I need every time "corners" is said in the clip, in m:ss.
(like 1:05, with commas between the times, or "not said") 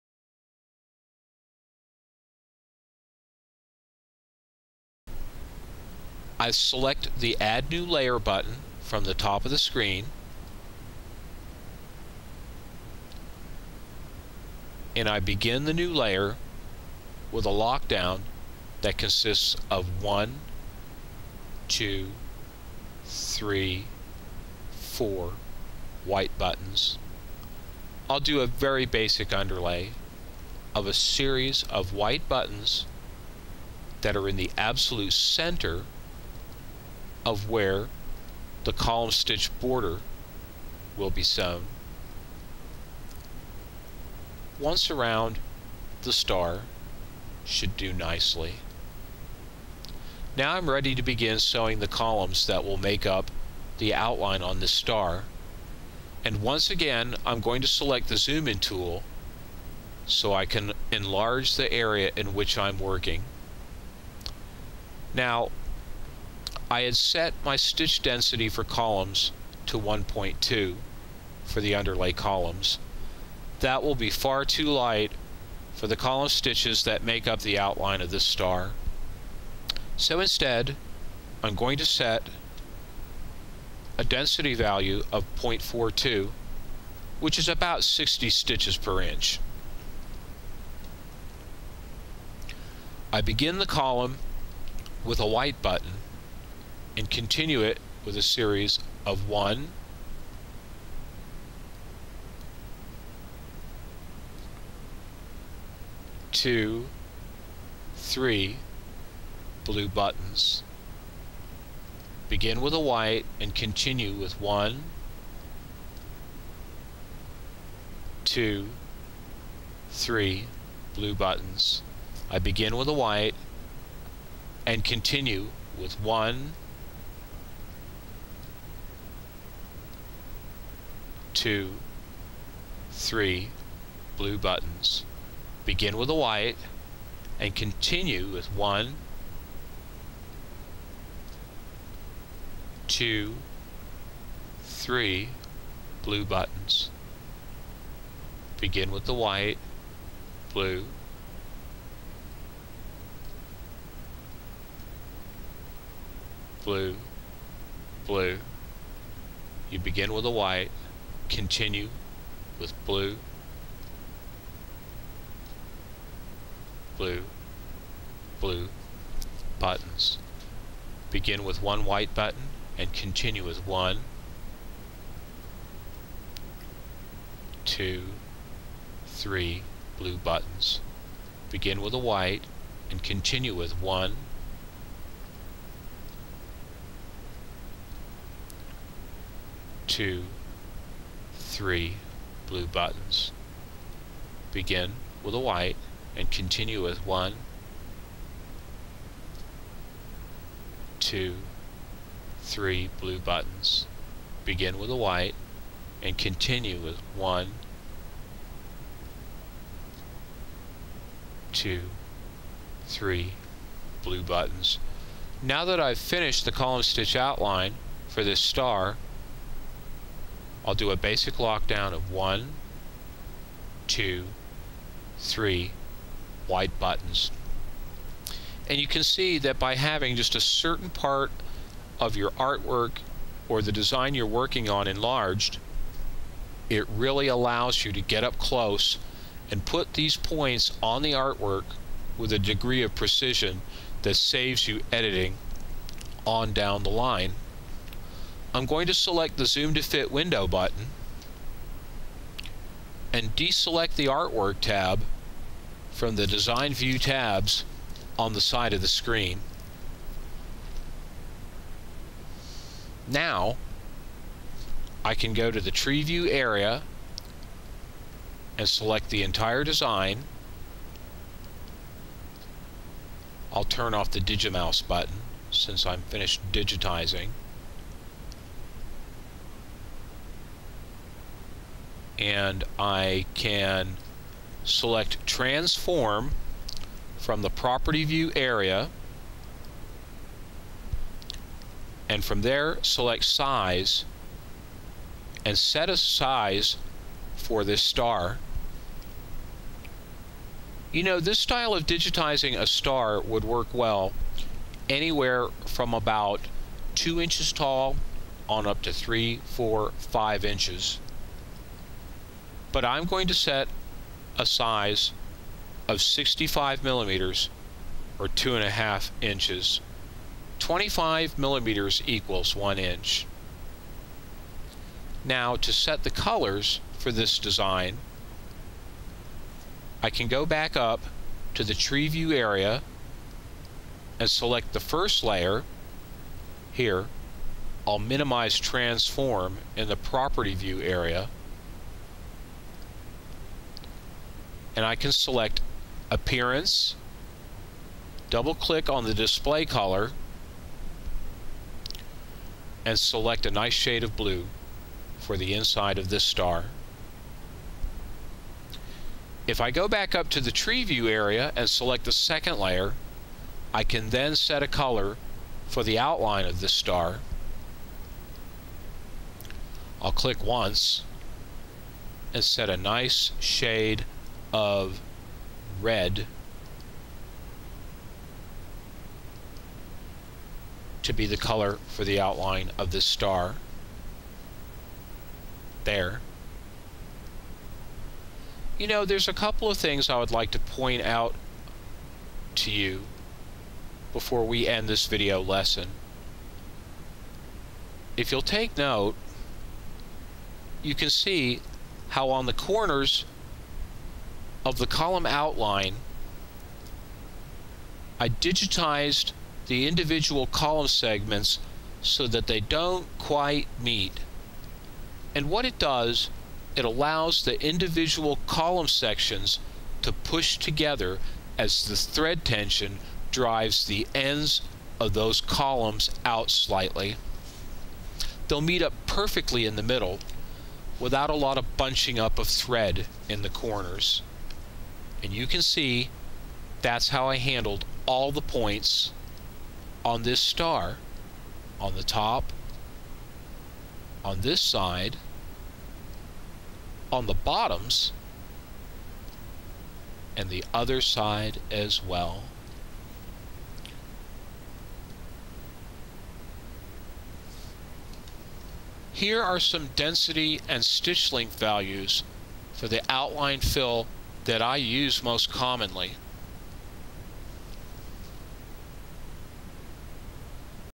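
6:42, 7:13.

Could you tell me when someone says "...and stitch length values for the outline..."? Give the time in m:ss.
7:40.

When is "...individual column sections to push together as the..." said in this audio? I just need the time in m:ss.
6:57.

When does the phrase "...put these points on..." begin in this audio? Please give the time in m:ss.
3:59.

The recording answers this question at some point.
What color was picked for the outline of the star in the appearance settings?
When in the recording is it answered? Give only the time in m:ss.
6:15.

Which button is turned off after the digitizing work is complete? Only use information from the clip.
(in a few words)
Digimouse.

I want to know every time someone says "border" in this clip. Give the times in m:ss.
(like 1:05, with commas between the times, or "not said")
0:39.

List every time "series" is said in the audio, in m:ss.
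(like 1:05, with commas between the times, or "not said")
0:30, 1:38.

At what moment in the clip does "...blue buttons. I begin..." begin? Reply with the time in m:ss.
2:00.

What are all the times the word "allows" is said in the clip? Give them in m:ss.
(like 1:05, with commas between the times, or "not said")
3:57, 6:56.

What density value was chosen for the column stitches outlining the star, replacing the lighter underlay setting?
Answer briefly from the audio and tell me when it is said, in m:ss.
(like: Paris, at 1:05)
0.42, at 1:25.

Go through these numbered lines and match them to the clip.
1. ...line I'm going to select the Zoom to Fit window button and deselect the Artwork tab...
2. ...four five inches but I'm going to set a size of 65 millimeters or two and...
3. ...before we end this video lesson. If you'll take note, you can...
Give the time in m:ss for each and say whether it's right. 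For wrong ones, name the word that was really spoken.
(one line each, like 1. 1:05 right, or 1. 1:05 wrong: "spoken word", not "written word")
1. 4:06 right
2. 5:09 right
3. 6:34 right.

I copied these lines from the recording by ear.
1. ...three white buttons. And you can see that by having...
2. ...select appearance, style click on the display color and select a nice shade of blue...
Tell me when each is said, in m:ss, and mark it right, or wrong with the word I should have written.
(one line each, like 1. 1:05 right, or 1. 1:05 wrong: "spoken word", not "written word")
1. 3:45 right
2. 5:45 wrong: "double", not "style".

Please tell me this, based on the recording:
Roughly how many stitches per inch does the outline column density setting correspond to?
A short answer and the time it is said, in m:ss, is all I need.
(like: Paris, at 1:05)
60, at 1:27.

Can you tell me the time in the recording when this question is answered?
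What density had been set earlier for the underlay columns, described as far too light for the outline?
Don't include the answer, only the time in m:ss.
1:09.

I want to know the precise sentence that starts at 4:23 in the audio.
Now, I can go to the tree view area and select the entire design.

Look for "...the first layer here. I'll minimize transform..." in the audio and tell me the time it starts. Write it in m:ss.
5:34.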